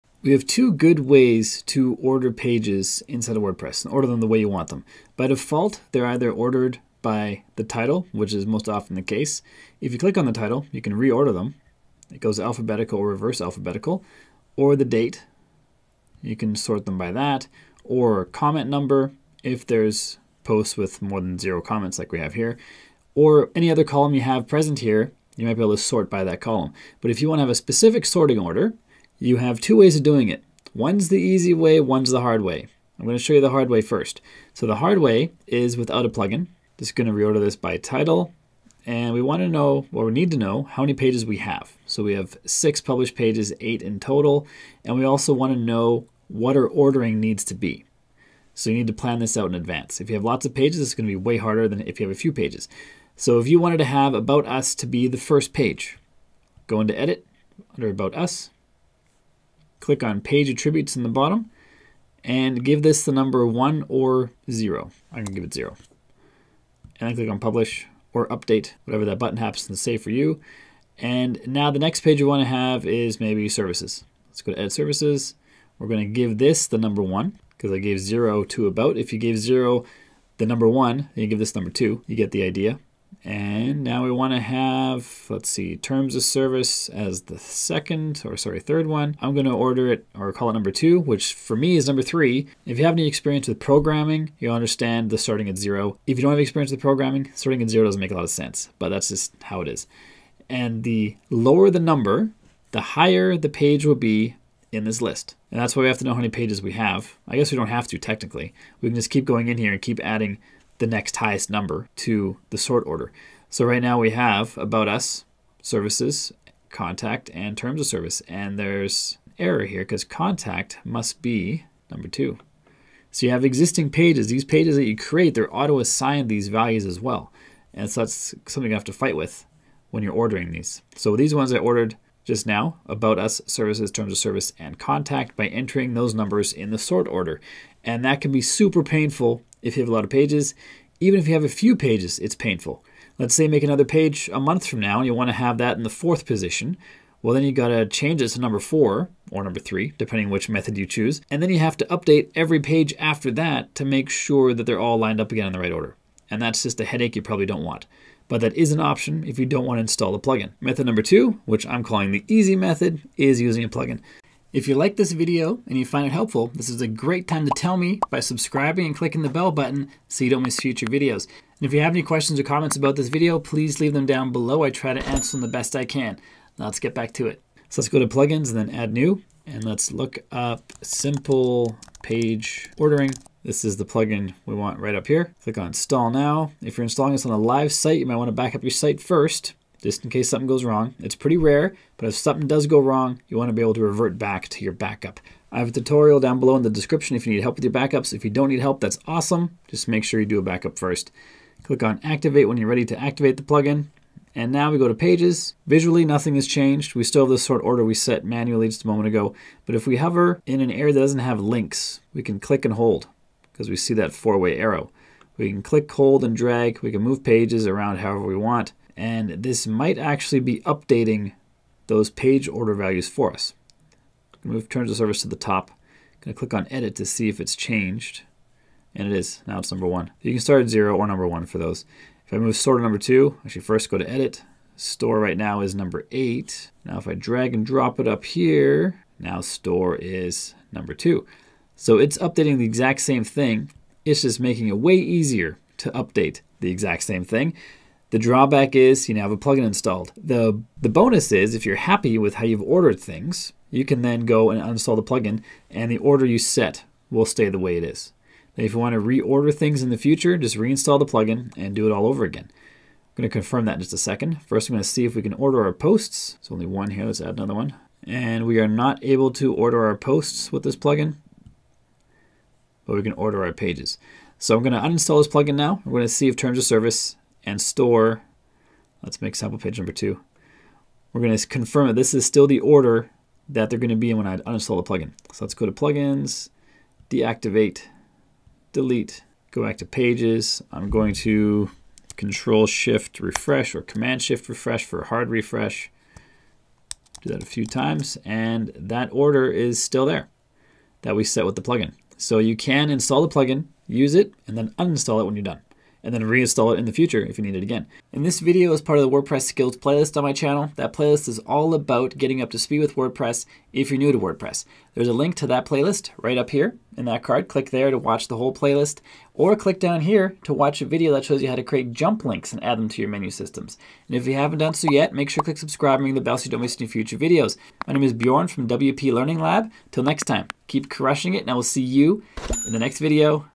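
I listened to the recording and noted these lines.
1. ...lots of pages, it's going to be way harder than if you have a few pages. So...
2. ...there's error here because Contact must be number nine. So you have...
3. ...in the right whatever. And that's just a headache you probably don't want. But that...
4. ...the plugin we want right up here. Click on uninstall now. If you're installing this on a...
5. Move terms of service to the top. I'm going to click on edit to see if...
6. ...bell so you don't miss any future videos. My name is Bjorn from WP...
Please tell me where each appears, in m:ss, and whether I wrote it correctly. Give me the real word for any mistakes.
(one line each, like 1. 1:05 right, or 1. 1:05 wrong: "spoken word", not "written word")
1. 0:50 right
2. 1:58 wrong: "two", not "nine"
3. 2:35 wrong: "order", not "whatever"
4. 3:03 wrong: "install", not "uninstall"
5. 3:44 right
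6. 5:26 right.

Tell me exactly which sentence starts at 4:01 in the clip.
So it's updating the exact same thing.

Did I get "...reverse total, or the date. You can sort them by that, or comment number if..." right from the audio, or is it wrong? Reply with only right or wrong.
wrong.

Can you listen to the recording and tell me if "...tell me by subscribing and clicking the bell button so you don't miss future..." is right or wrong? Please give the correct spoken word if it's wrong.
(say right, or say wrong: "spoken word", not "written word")
right.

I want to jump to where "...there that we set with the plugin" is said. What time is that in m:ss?
5:00.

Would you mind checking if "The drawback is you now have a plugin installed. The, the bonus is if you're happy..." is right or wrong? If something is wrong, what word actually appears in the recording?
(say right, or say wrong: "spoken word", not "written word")
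right.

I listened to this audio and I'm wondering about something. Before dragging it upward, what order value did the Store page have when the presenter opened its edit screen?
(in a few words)
8.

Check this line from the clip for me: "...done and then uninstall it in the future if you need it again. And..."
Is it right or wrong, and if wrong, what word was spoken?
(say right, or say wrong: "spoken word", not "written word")
wrong: "reinstall", not "uninstall".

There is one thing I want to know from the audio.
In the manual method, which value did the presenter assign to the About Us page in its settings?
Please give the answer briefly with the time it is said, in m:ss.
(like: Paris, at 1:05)
0, at 1:05.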